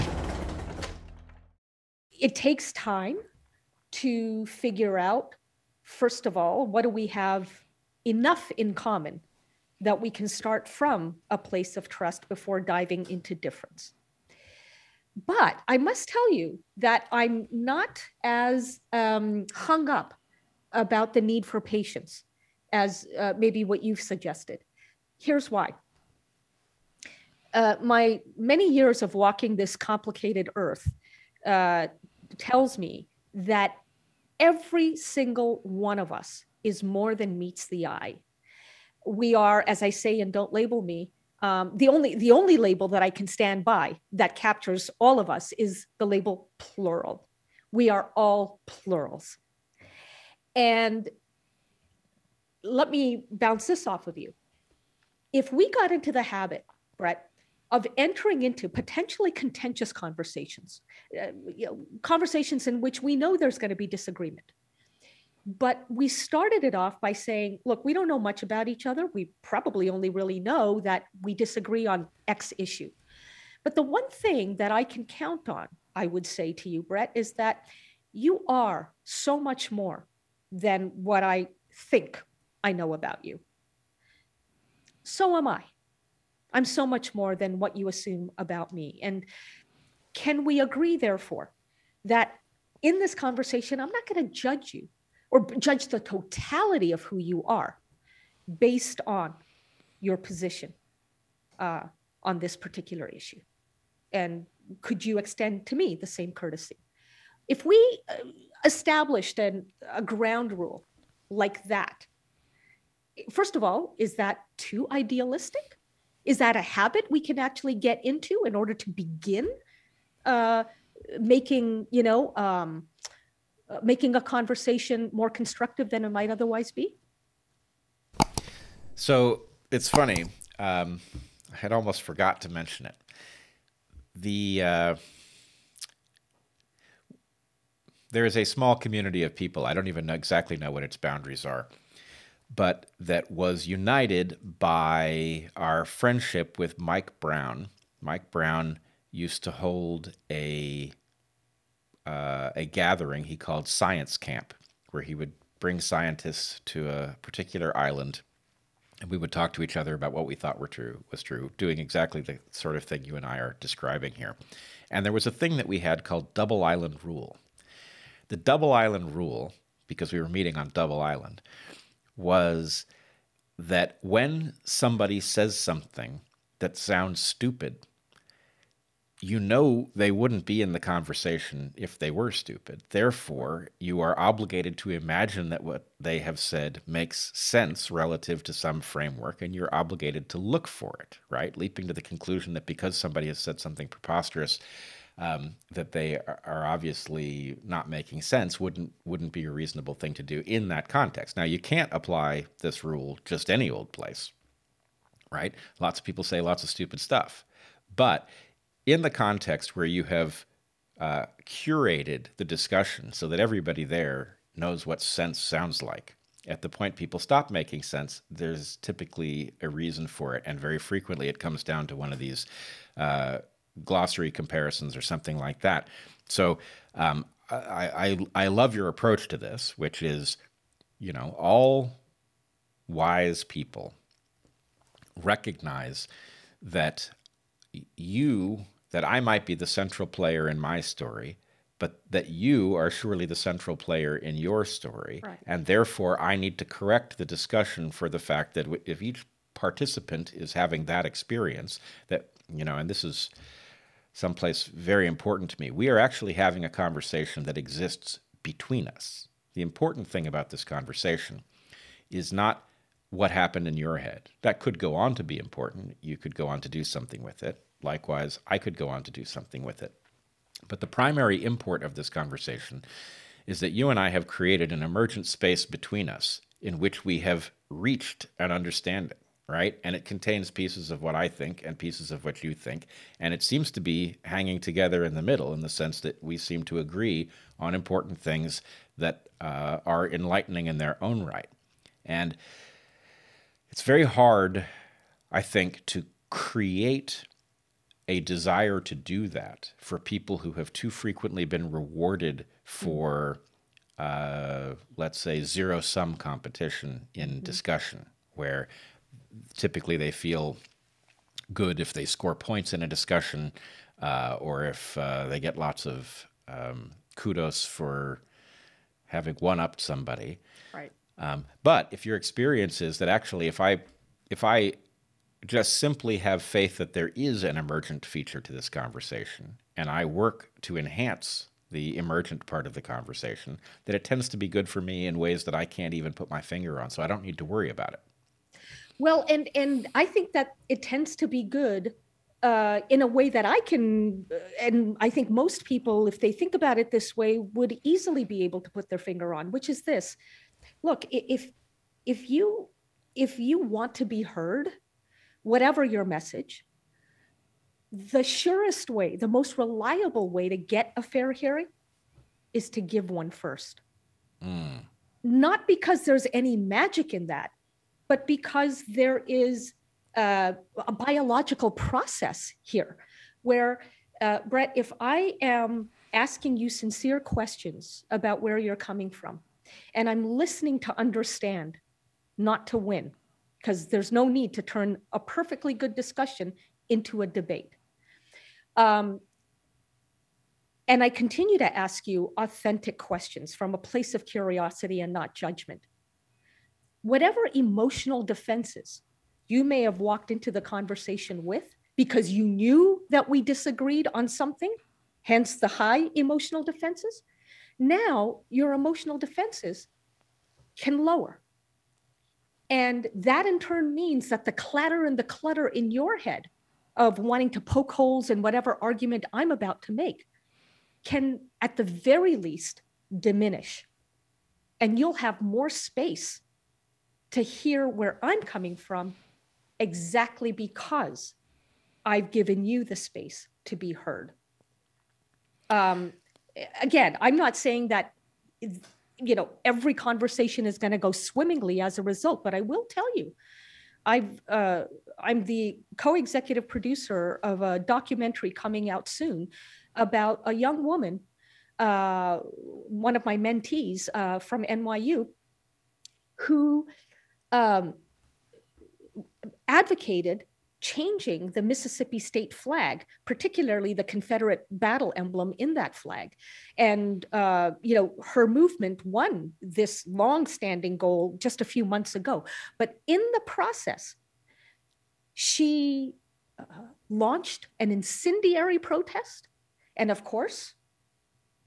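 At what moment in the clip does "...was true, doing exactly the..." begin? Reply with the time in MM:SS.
02:41.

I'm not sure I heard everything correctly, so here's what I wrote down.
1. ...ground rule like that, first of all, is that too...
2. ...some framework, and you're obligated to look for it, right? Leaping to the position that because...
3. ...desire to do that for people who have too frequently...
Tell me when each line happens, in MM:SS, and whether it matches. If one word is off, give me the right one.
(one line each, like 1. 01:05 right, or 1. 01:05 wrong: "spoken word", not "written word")
1. 01:50 right
2. 03:08 wrong: "conclusion", not "position"
3. 04:58 right.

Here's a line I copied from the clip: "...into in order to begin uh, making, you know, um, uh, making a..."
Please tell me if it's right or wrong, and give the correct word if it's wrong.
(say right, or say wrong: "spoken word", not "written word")
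right.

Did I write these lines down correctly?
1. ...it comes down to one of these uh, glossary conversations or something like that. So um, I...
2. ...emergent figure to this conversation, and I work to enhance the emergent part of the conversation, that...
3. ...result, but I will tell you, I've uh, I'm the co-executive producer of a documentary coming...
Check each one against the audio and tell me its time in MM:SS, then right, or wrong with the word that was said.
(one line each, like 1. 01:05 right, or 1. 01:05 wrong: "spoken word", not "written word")
1. 03:41 wrong: "comparisons", not "conversations"
2. 05:27 wrong: "feature", not "figure"
3. 07:22 right.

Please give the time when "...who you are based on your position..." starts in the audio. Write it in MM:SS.
01:37.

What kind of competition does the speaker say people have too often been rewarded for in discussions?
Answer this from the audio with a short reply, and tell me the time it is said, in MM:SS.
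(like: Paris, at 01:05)
zero sum competition, at 05:05.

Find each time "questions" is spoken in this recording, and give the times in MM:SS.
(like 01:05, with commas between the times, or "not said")
06:17, 06:32.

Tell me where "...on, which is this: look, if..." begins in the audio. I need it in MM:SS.
05:49.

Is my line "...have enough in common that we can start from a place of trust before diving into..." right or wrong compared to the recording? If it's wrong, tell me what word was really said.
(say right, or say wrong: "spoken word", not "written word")
right.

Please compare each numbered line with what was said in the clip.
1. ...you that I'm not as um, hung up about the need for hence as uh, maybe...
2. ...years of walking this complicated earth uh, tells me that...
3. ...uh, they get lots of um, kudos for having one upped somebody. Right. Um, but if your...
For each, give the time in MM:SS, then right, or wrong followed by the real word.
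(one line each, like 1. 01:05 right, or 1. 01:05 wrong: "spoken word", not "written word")
1. 00:16 wrong: "patience", not "hence"
2. 00:28 right
3. 05:14 right.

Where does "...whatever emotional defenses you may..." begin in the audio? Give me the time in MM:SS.
06:37.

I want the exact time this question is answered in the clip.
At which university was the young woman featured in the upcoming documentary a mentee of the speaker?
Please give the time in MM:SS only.
07:34.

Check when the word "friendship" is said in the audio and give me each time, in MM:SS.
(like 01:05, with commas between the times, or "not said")
02:25.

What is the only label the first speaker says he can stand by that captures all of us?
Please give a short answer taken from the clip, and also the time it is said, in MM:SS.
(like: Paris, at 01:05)
plural, at 00:46.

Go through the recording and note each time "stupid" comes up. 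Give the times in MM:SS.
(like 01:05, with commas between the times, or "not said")
02:57, 03:02, 03:26.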